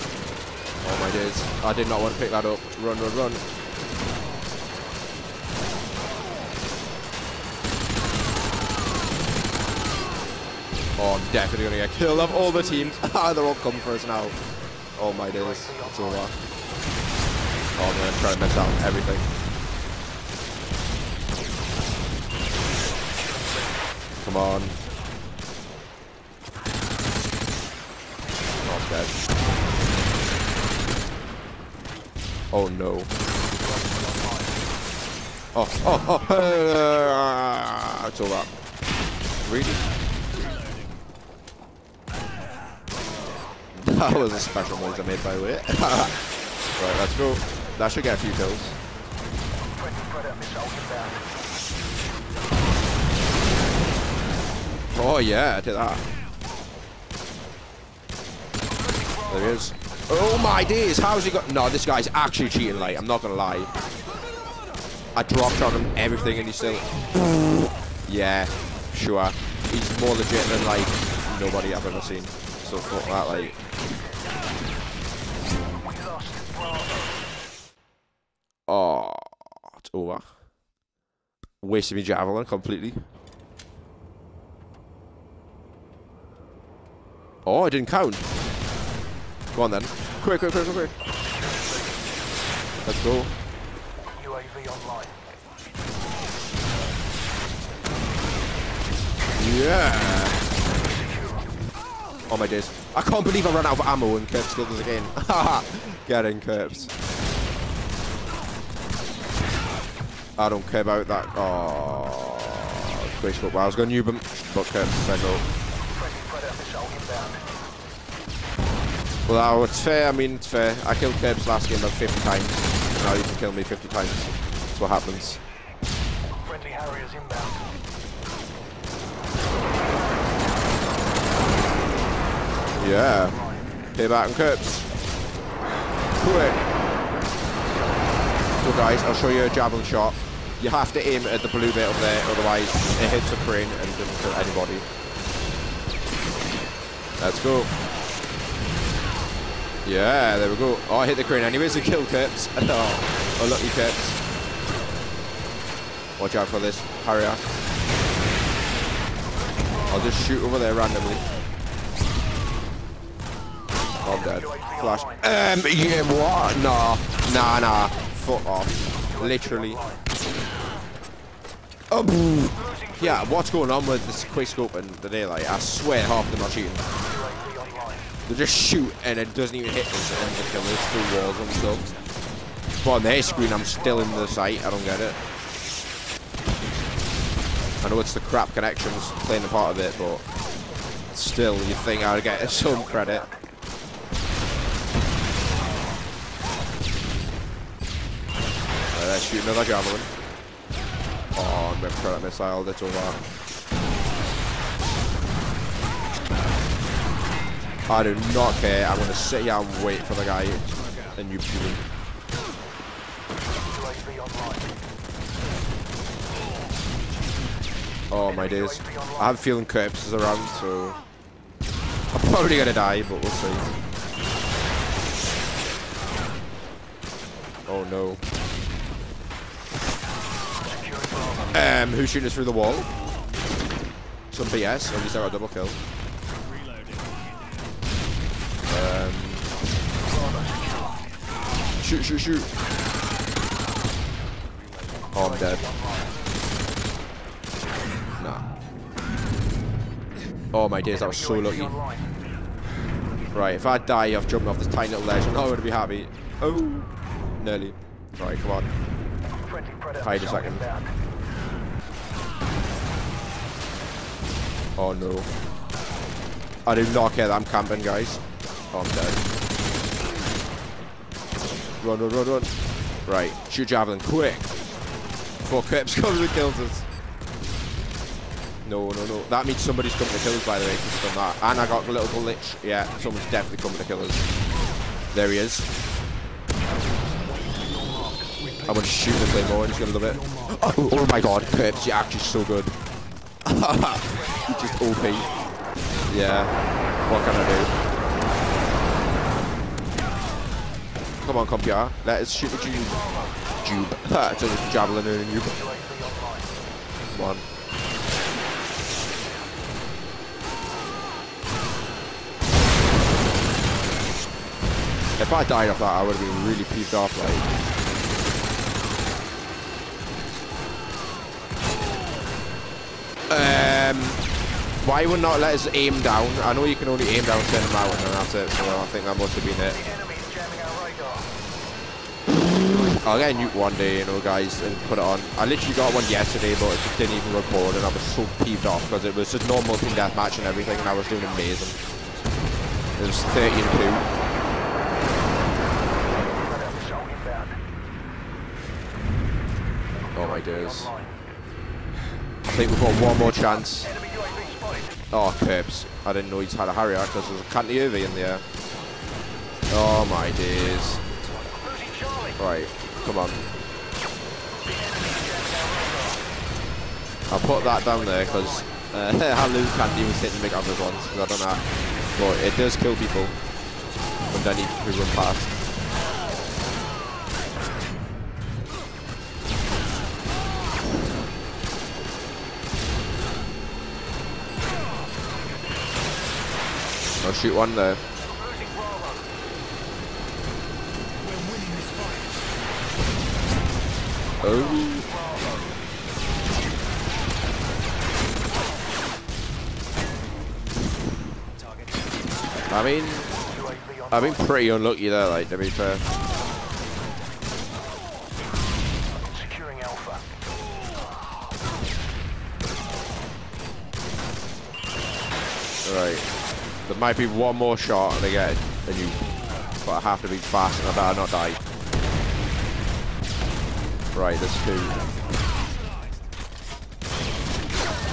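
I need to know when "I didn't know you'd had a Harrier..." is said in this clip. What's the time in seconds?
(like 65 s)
356 s.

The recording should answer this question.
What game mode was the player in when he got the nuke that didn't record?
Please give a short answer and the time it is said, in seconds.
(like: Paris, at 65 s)
team deathmatch, at 339 s.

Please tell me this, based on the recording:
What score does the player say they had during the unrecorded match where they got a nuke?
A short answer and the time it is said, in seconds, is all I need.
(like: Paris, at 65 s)
13-2, at 343 s.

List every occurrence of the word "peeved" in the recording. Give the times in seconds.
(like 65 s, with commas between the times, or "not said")
316 s, 338 s.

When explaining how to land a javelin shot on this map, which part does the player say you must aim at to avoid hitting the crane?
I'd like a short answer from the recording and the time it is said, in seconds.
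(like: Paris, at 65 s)
the blue bit, at 141 s.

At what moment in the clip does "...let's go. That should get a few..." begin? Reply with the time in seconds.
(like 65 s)
46 s.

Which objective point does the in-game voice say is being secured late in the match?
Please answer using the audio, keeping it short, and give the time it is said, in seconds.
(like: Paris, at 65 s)
Alpha, at 409 s.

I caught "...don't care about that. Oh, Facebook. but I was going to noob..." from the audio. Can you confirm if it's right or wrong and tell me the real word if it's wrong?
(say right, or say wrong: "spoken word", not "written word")
right.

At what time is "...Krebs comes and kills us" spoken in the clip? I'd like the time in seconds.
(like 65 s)
275 s.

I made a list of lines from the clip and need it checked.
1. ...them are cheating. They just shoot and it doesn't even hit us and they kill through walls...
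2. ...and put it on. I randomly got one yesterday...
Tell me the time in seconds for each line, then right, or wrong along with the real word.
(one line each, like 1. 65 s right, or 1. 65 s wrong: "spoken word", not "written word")
1. 176 s right
2. 334 s wrong: "literally", not "randomly".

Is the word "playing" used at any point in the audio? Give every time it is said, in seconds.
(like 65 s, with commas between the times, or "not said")
189 s.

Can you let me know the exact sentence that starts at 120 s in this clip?
I killed Kerbs last game about 50 times.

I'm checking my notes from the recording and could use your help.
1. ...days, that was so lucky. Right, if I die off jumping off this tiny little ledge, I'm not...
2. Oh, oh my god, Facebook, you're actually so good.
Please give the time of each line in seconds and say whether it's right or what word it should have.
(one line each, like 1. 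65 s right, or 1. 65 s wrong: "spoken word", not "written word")
1. 250 s right
2. 290 s wrong: "Krebs", not "Facebook".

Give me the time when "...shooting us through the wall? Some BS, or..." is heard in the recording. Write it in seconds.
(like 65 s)
232 s.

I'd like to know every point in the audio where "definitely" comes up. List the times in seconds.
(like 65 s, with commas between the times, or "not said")
11 s, 283 s.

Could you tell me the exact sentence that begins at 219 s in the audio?
I have a feeling corpses is around, so...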